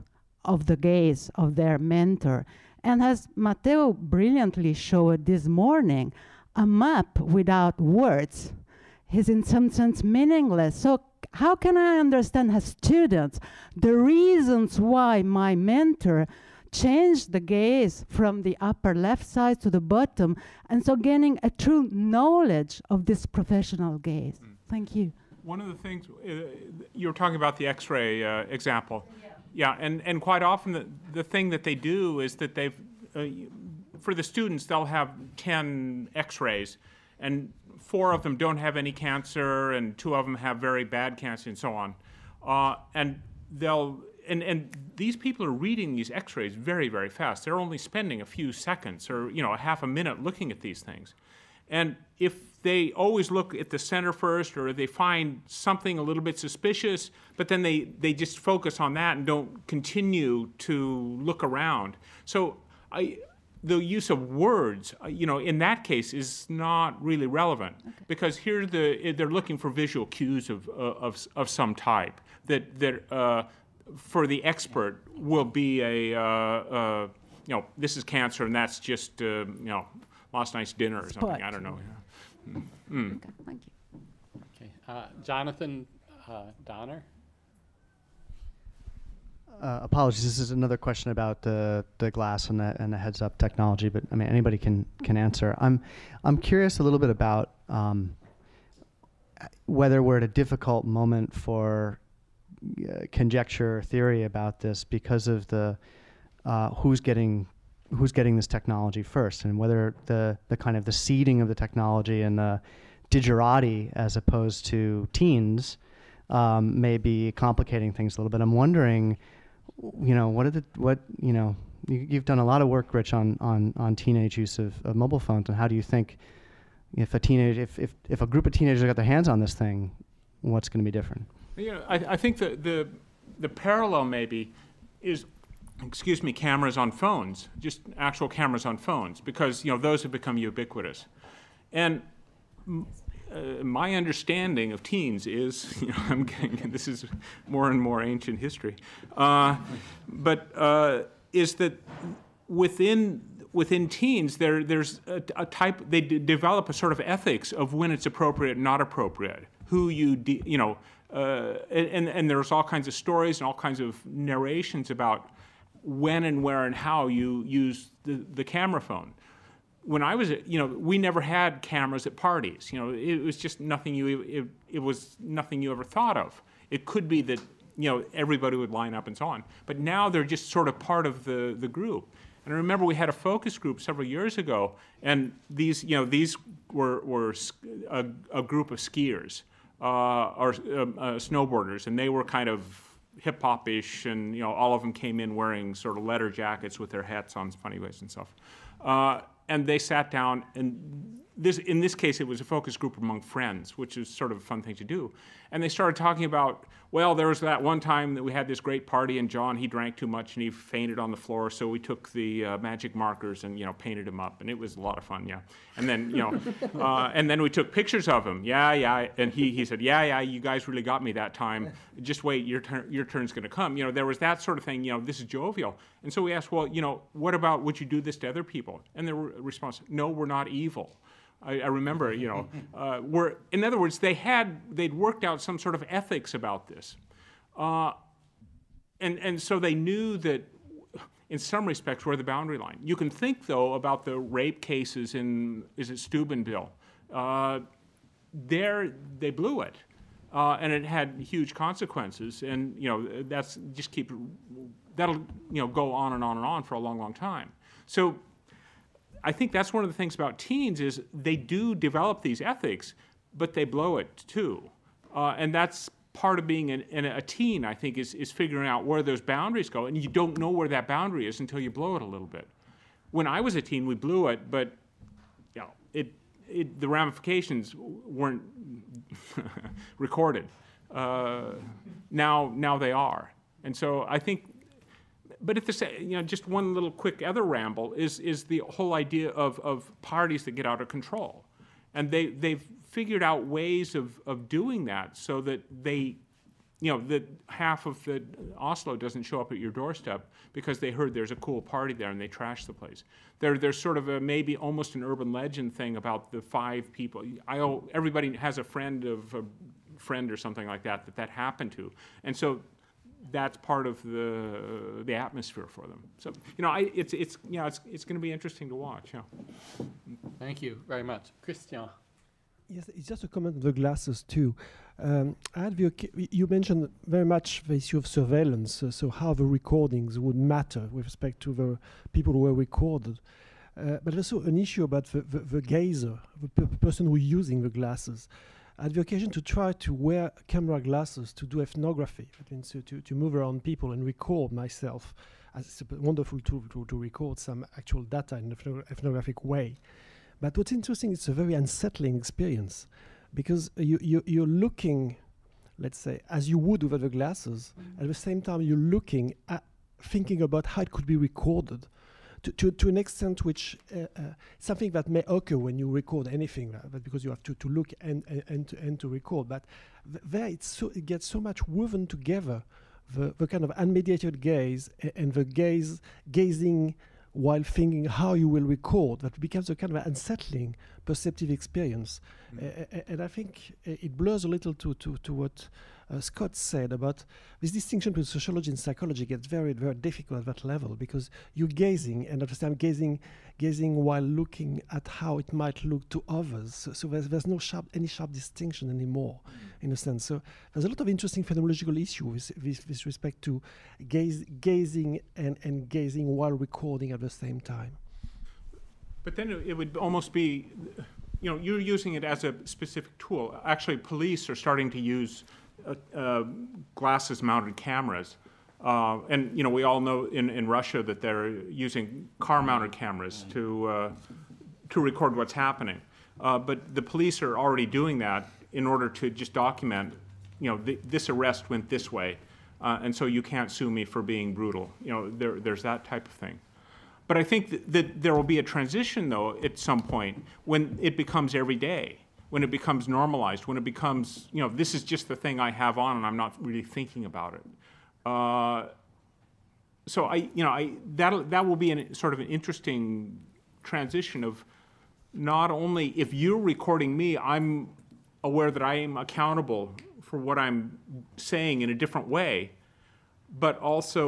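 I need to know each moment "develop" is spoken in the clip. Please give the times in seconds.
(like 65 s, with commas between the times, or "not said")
156 s, 261 s.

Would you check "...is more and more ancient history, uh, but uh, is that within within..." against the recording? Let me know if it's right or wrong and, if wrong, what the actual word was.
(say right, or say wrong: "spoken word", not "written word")
right.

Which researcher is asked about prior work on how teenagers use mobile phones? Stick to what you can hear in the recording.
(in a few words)
Rich.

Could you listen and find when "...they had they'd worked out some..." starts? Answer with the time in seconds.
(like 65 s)
233 s.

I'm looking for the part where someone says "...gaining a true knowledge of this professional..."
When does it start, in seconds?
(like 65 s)
20 s.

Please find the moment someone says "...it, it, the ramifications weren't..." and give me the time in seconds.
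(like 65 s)
275 s.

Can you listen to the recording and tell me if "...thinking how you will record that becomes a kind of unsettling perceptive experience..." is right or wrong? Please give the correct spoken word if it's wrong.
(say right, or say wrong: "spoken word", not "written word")
right.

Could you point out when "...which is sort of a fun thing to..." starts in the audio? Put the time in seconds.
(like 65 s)
203 s.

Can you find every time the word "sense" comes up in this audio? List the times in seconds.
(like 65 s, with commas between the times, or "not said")
9 s, 399 s.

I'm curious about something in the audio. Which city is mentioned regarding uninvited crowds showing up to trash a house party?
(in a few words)
Oslo.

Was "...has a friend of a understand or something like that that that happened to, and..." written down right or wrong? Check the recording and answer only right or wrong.
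wrong.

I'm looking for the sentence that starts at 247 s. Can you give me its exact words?
Uh, there they blew it, uh, and it had huge consequences.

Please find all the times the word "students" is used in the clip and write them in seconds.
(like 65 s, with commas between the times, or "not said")
12 s, 34 s.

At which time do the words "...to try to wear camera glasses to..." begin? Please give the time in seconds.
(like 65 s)
339 s.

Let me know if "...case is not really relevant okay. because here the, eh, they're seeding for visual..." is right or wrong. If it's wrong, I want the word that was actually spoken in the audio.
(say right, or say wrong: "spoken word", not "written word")
wrong: "looking", not "seeding".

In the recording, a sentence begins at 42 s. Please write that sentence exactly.
Uh, and they'll, and, and these people are reading these x rays very, very fast.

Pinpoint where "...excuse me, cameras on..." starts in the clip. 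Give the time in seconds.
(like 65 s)
135 s.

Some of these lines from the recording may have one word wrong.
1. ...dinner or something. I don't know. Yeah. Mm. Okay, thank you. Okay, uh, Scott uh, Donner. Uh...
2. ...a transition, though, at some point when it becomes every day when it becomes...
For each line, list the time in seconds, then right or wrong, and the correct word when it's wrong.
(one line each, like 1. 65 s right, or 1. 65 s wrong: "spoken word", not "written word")
1. 80 s wrong: "Jonathan", not "Scott"
2. 438 s right.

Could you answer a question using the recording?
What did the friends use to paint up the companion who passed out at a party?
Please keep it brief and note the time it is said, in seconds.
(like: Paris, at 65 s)
magic markers, at 212 s.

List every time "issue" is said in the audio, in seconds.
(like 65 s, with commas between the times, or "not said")
327 s, 334 s, 402 s.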